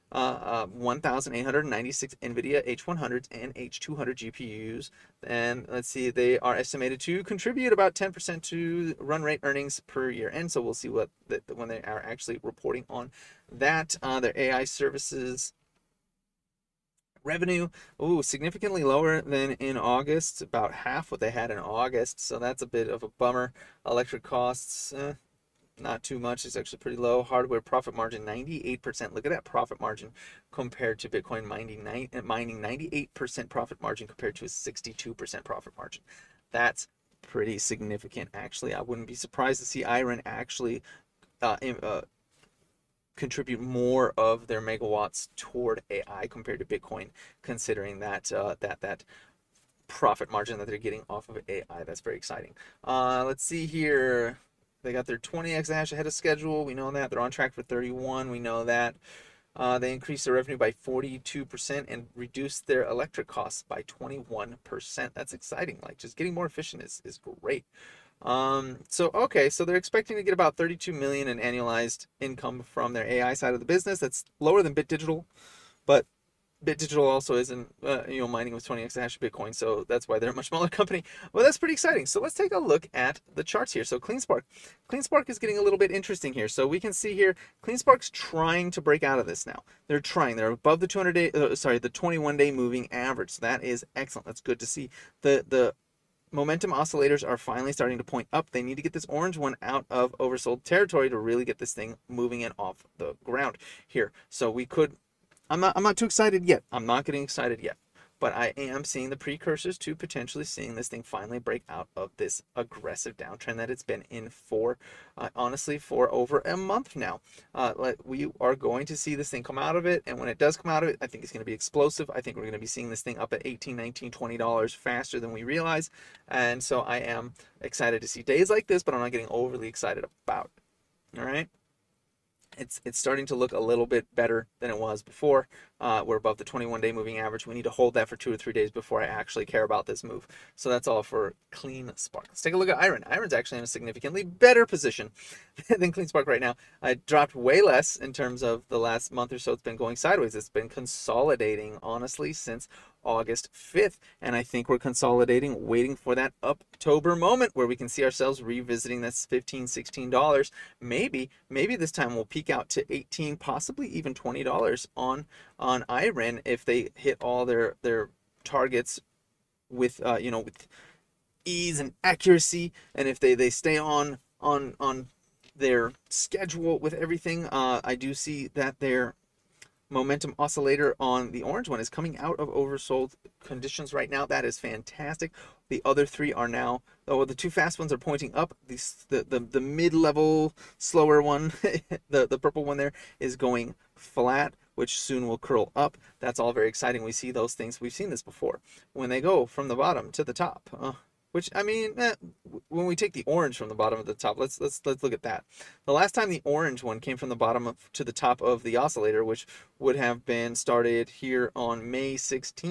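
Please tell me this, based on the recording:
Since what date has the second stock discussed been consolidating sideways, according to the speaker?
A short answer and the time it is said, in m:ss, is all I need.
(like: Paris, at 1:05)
August 5th, at 2:33.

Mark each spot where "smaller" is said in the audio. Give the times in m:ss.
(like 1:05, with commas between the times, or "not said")
1:20.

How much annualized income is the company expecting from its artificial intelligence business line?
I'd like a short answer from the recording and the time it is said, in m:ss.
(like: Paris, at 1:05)
32 million, at 1:10.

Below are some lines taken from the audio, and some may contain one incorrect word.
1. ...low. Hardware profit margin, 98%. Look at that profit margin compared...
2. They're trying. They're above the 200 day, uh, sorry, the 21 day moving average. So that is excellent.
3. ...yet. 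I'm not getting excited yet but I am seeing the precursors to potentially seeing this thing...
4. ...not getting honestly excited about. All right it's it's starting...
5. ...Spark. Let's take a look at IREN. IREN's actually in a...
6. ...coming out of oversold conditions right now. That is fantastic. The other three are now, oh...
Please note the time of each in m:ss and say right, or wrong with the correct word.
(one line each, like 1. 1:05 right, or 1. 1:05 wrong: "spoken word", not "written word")
1. 0:26 right
2. 1:29 right
3. 1:46 right
4. 2:08 wrong: "overly", not "honestly"
5. 2:21 right
6. 3:01 right.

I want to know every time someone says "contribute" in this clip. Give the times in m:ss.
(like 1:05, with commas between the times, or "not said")
0:07, 0:43.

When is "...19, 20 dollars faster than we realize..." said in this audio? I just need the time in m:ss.
2:03.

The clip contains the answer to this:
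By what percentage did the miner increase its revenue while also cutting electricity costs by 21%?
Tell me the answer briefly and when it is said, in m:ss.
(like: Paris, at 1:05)
42%, at 1:00.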